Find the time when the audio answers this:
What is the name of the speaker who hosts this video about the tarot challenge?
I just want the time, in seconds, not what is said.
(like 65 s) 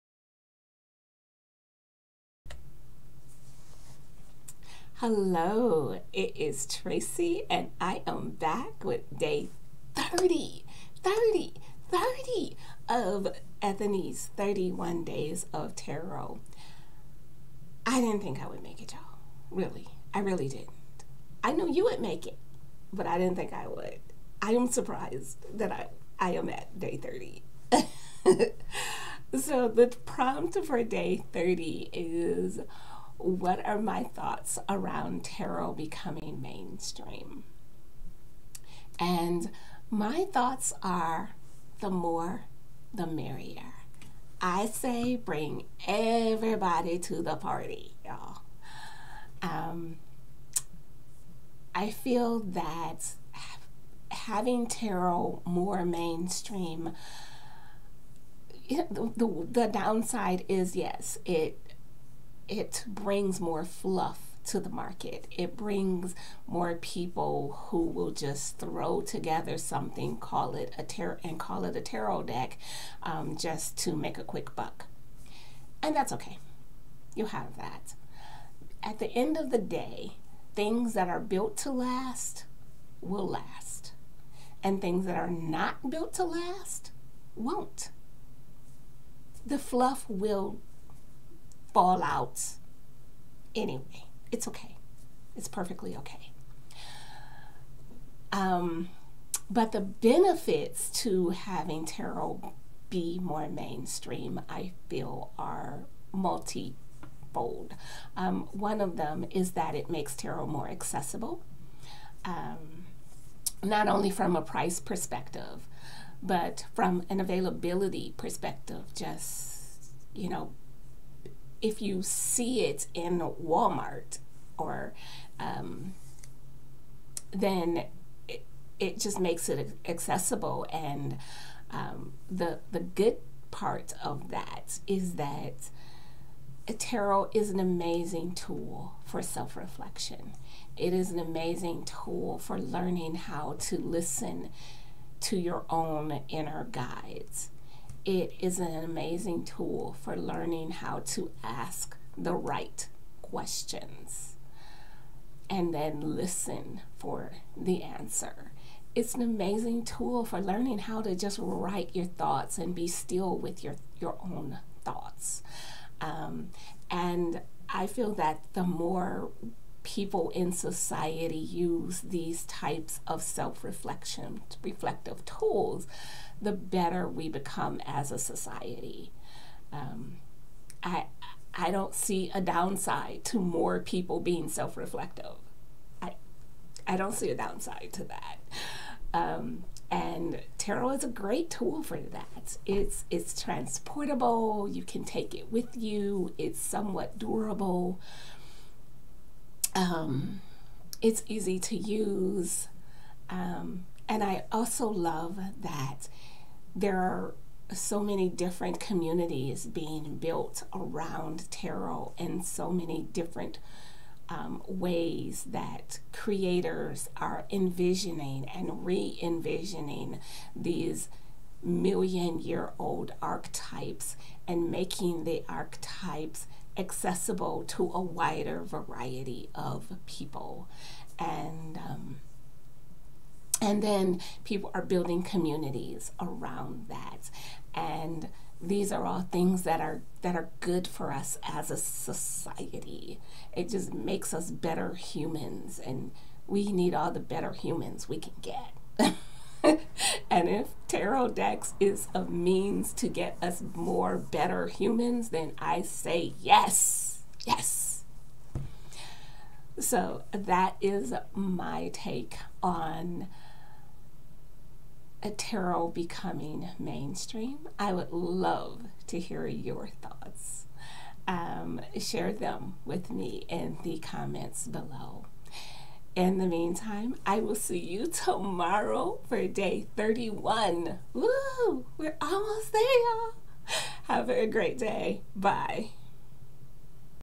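6 s.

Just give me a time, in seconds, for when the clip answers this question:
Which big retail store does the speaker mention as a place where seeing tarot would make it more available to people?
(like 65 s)
123 s.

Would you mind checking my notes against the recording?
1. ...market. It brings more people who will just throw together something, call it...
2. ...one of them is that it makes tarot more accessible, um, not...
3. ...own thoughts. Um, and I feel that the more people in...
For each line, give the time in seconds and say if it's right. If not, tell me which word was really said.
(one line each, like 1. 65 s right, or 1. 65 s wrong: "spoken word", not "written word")
1. 64 s right
2. 108 s right
3. 164 s right.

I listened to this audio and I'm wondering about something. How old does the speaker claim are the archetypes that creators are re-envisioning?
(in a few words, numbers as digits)
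million year old.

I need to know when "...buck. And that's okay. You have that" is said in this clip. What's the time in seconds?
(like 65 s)
74 s.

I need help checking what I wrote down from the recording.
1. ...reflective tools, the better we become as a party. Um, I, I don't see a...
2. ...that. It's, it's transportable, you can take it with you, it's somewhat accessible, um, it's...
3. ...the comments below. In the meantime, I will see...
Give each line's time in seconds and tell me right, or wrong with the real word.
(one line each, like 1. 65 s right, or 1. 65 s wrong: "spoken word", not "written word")
1. 174 s wrong: "society", not "party"
2. 191 s wrong: "durable", not "accessible"
3. 273 s right.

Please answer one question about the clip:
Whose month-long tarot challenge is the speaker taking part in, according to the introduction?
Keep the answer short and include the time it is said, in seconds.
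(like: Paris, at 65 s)
Ethany, at 13 s.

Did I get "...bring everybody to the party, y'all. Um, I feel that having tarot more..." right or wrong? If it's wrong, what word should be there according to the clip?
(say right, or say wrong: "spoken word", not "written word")
right.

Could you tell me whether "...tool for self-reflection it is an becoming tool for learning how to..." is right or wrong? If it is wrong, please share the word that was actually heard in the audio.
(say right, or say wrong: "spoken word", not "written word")
wrong: "amazing", not "becoming".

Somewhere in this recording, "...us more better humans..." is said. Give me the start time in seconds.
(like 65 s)
253 s.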